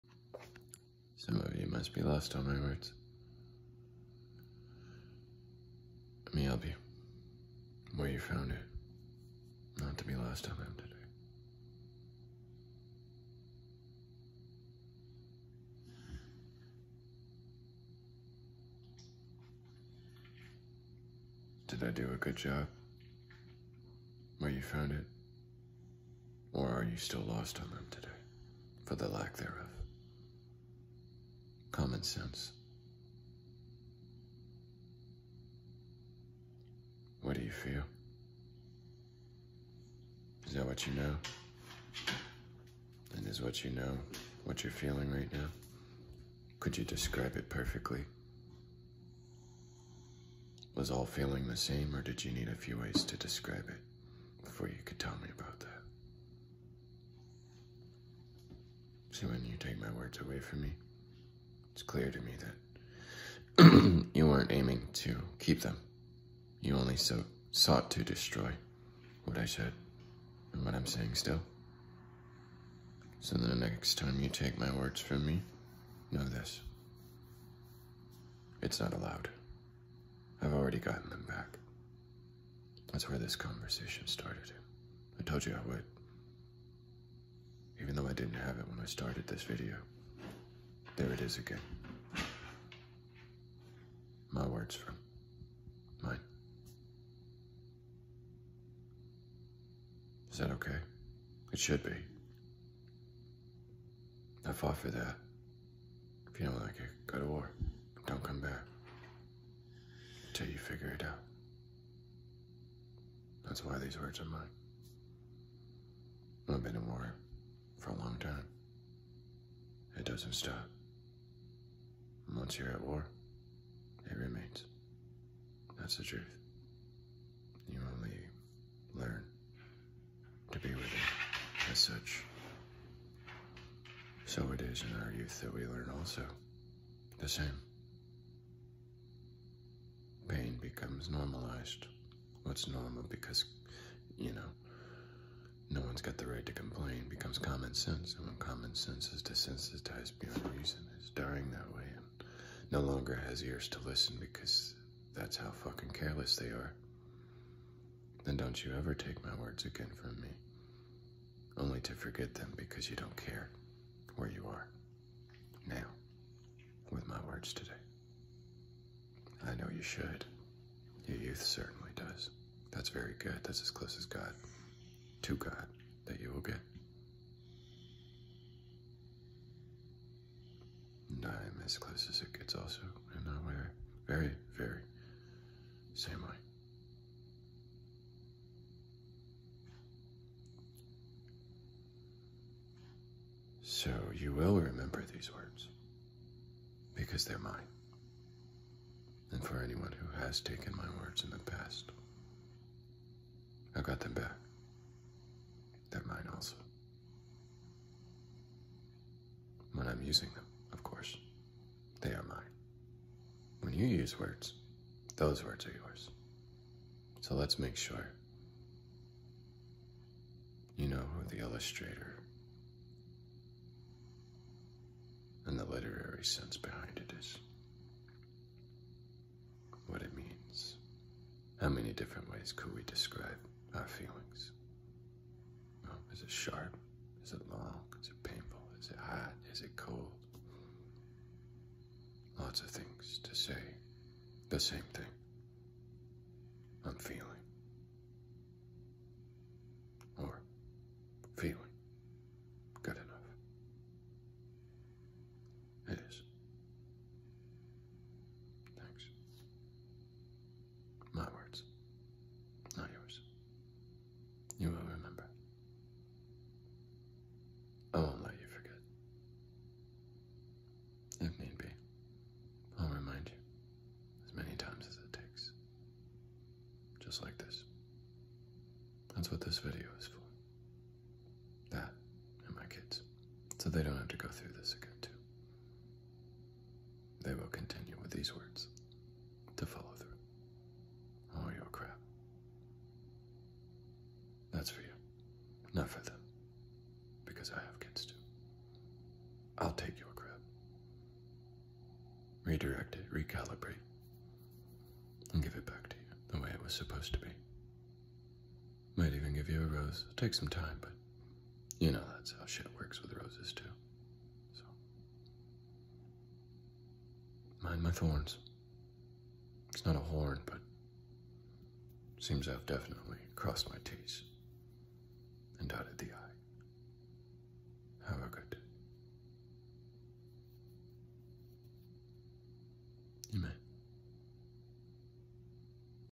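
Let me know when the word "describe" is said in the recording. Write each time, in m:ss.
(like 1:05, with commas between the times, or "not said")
0:46, 0:53, 3:52.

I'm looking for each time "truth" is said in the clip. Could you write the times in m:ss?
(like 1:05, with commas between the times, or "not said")
2:06.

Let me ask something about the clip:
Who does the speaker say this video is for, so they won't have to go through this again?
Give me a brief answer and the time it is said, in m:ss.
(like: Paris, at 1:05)
my kids, at 4:42.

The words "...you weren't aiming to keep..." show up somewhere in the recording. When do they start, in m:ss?
1:04.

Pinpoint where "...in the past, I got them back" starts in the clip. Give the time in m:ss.
3:21.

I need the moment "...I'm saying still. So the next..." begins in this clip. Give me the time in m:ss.
1:10.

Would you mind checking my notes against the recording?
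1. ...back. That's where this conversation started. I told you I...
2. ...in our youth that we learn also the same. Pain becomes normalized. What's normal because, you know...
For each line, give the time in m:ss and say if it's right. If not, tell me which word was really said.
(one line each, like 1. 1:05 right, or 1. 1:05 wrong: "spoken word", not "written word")
1. 1:21 right
2. 2:14 right.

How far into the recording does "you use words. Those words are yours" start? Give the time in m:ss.
3:33.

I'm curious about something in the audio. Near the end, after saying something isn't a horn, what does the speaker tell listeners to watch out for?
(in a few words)
thorns.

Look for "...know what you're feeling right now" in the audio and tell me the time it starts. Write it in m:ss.
0:43.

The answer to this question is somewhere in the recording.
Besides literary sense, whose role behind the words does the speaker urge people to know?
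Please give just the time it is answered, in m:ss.
3:41.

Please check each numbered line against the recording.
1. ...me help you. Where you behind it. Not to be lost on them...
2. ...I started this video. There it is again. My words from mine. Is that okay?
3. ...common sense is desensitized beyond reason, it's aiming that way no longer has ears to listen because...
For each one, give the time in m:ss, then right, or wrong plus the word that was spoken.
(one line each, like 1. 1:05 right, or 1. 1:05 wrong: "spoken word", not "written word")
1. 0:06 wrong: "found", not "behind"
2. 1:28 right
3. 2:28 wrong: "dying", not "aiming".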